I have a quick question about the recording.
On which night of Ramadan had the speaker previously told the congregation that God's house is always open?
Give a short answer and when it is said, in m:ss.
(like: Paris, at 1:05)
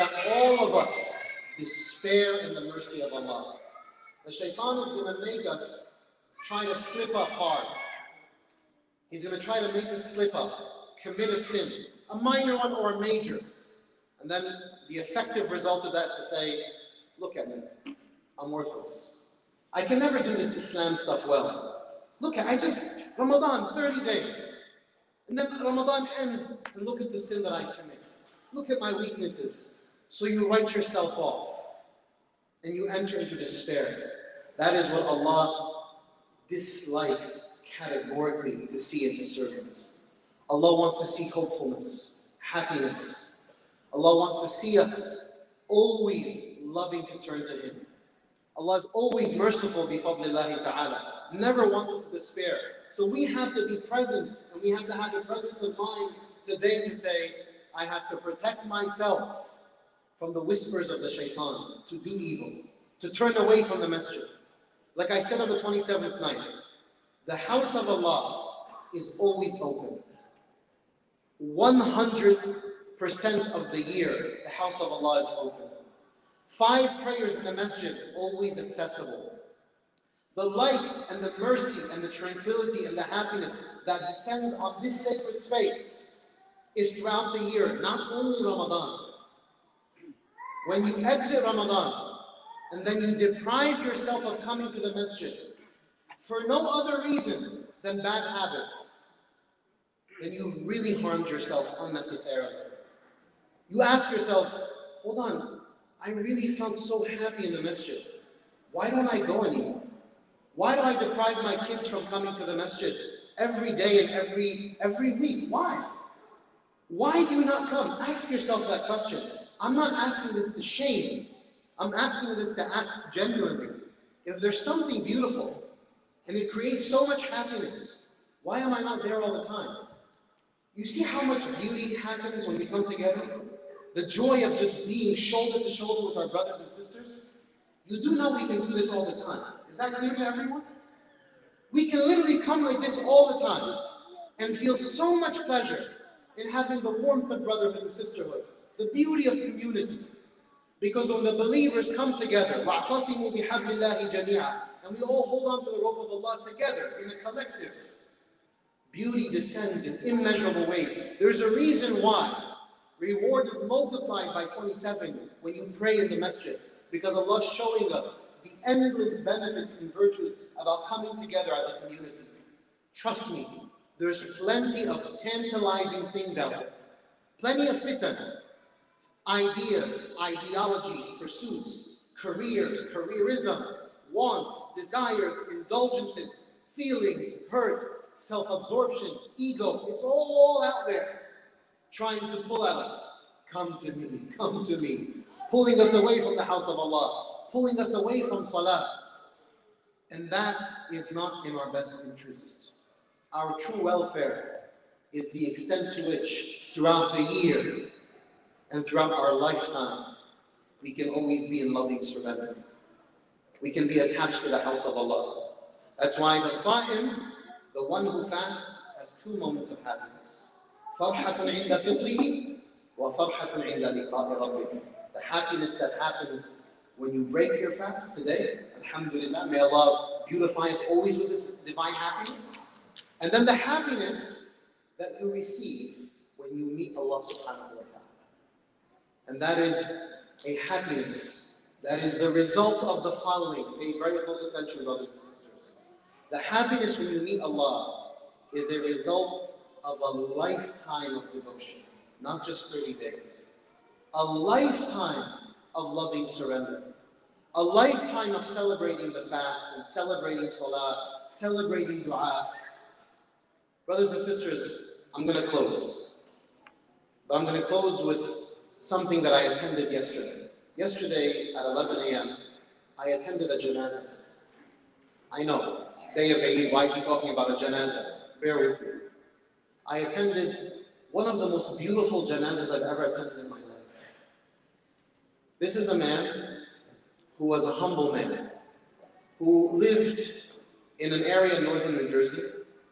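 27th night, at 1:05.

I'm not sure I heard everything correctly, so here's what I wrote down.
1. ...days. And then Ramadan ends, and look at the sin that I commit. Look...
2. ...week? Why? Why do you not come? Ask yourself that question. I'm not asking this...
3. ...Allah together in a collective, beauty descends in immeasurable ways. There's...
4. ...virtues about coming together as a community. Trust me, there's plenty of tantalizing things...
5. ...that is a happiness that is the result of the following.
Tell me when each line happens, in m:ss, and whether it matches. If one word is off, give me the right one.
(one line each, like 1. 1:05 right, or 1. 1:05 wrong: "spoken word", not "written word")
1. 0:24 right
2. 1:55 right
3. 2:36 right
4. 2:49 right
5. 3:59 right.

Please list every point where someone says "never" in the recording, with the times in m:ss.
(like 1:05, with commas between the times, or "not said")
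0:19, 0:51.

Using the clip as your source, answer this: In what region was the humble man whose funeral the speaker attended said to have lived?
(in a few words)
northern New Jersey.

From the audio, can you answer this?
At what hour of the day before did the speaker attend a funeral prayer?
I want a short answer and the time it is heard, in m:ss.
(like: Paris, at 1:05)
11 a.m., at 4:31.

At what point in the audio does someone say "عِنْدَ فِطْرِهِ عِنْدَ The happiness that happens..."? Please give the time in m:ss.
3:40.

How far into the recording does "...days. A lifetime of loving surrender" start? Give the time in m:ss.
4:12.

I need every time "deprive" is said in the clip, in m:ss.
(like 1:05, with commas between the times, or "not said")
1:33, 1:50.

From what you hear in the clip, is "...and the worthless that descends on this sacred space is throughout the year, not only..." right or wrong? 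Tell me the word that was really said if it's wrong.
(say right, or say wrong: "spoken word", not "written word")
wrong: "happiness", not "worthless".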